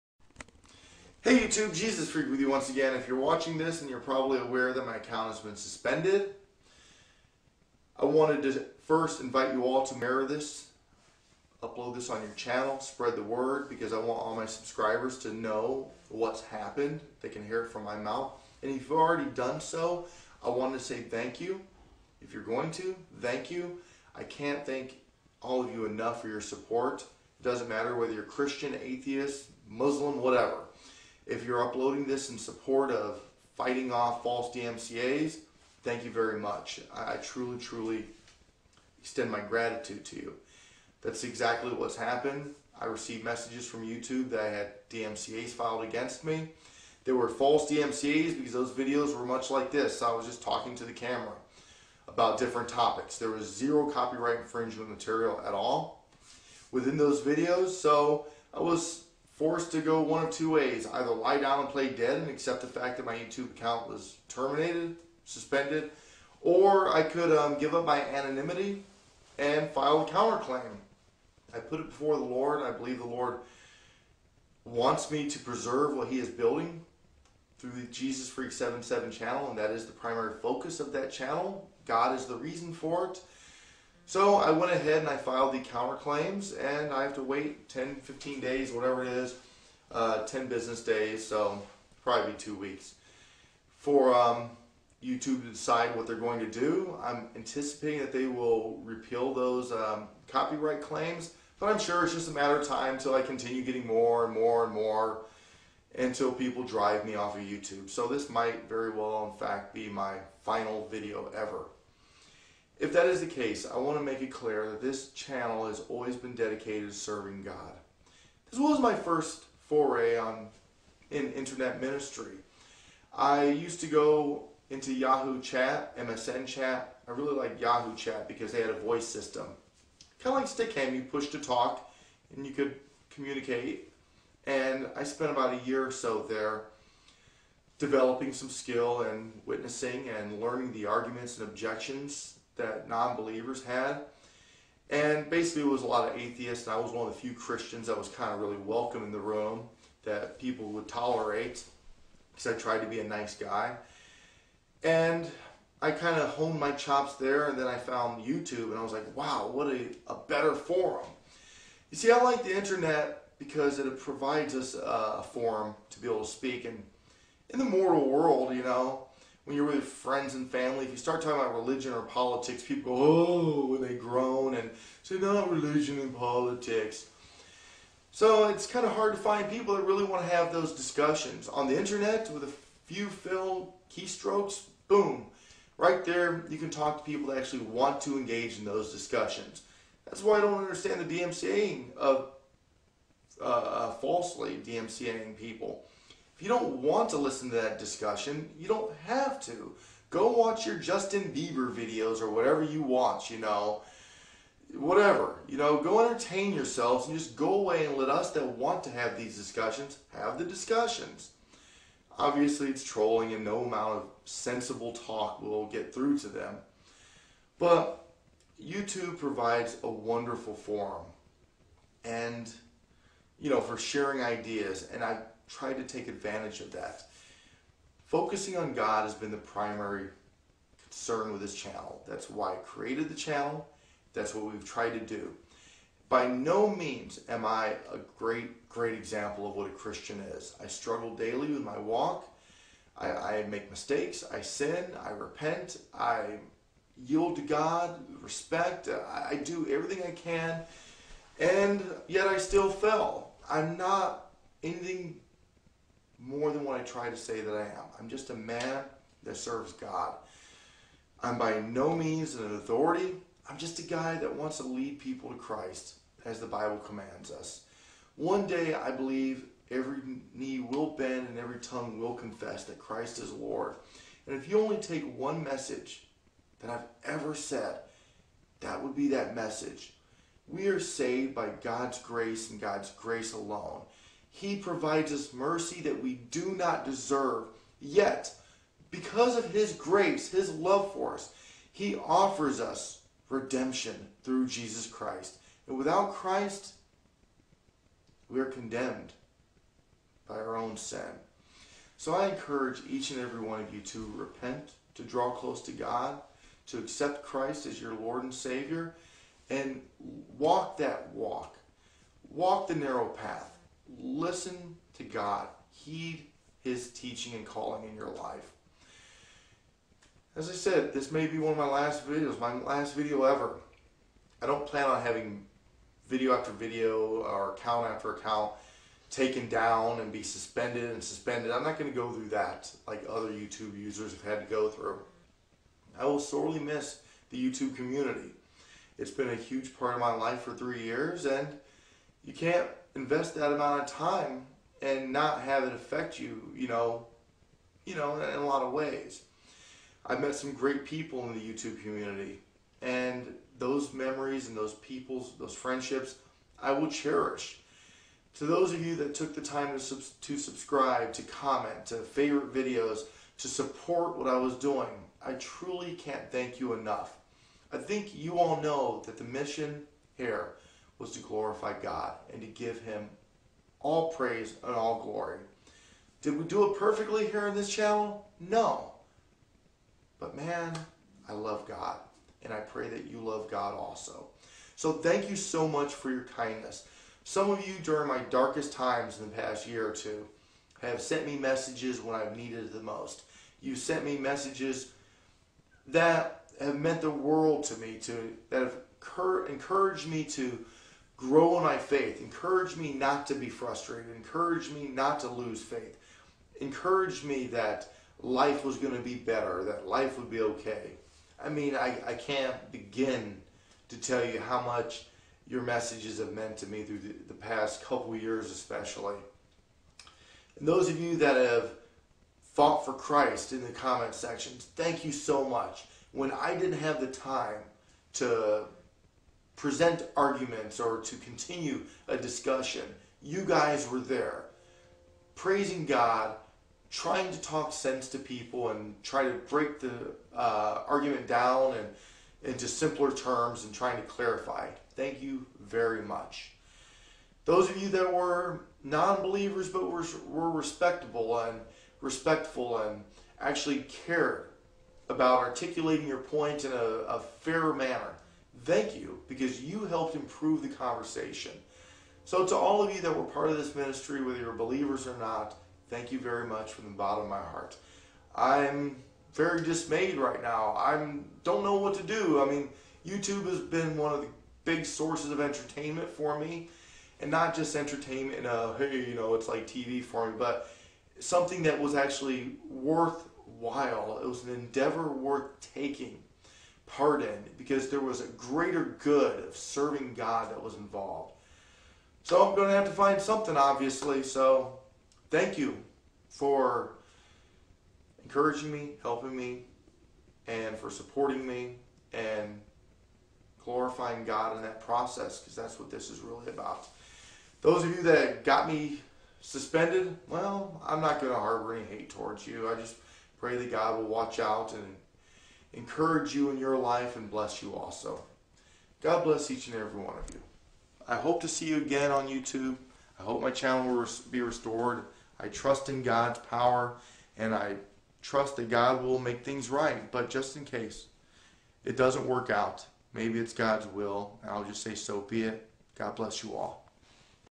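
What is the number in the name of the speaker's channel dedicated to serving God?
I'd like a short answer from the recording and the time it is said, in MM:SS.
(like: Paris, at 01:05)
77, at 01:17.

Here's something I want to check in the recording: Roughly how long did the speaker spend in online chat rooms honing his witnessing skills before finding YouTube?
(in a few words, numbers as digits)
about a year.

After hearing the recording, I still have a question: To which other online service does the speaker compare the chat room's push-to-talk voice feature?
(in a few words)
Stickam.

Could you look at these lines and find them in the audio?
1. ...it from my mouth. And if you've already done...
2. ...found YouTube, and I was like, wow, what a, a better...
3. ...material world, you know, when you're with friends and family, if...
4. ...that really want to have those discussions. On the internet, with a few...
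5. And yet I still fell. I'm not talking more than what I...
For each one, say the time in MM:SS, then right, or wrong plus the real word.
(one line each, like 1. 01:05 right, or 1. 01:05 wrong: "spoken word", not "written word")
1. 00:17 right
2. 02:37 right
3. 02:47 wrong: "mortal", not "material"
4. 02:59 right
5. 04:11 wrong: "anything", not "talking".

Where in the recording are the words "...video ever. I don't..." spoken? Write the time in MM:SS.
05:22.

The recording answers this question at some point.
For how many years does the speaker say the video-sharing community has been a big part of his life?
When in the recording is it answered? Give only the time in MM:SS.
05:40.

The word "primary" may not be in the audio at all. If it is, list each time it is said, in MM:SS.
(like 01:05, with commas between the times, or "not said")
01:19, 03:49.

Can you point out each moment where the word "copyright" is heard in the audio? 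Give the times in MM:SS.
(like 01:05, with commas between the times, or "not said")
00:53, 01:40.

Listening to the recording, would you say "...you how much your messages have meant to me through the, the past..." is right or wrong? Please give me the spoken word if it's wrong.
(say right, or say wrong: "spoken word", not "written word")
right.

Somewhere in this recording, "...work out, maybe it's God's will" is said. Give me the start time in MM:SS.
08:52.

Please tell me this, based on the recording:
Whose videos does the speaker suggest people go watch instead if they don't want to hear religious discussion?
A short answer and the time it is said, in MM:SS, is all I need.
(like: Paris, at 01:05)
Justin Bieber, at 03:20.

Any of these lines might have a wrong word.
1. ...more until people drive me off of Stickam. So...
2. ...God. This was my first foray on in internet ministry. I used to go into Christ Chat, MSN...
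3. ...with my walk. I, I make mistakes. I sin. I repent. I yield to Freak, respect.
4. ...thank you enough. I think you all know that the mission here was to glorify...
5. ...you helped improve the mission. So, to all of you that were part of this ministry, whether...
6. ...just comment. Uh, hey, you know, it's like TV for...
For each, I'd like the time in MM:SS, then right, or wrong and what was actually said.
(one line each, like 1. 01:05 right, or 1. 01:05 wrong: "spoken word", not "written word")
1. 01:44 wrong: "YouTube", not "Stickam"
2. 01:57 wrong: "Yahoo", not "Christ"
3. 04:01 wrong: "God", not "Freak"
4. 06:06 right
5. 07:39 wrong: "conversation", not "mission"
6. 07:57 wrong: "entertainment", not "comment".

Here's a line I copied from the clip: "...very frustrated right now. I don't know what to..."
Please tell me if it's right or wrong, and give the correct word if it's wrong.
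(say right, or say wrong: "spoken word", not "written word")
wrong: "dismayed", not "frustrated".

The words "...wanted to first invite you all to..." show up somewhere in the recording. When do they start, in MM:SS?
00:08.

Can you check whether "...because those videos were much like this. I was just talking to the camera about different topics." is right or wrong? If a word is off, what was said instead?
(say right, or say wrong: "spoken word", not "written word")
right.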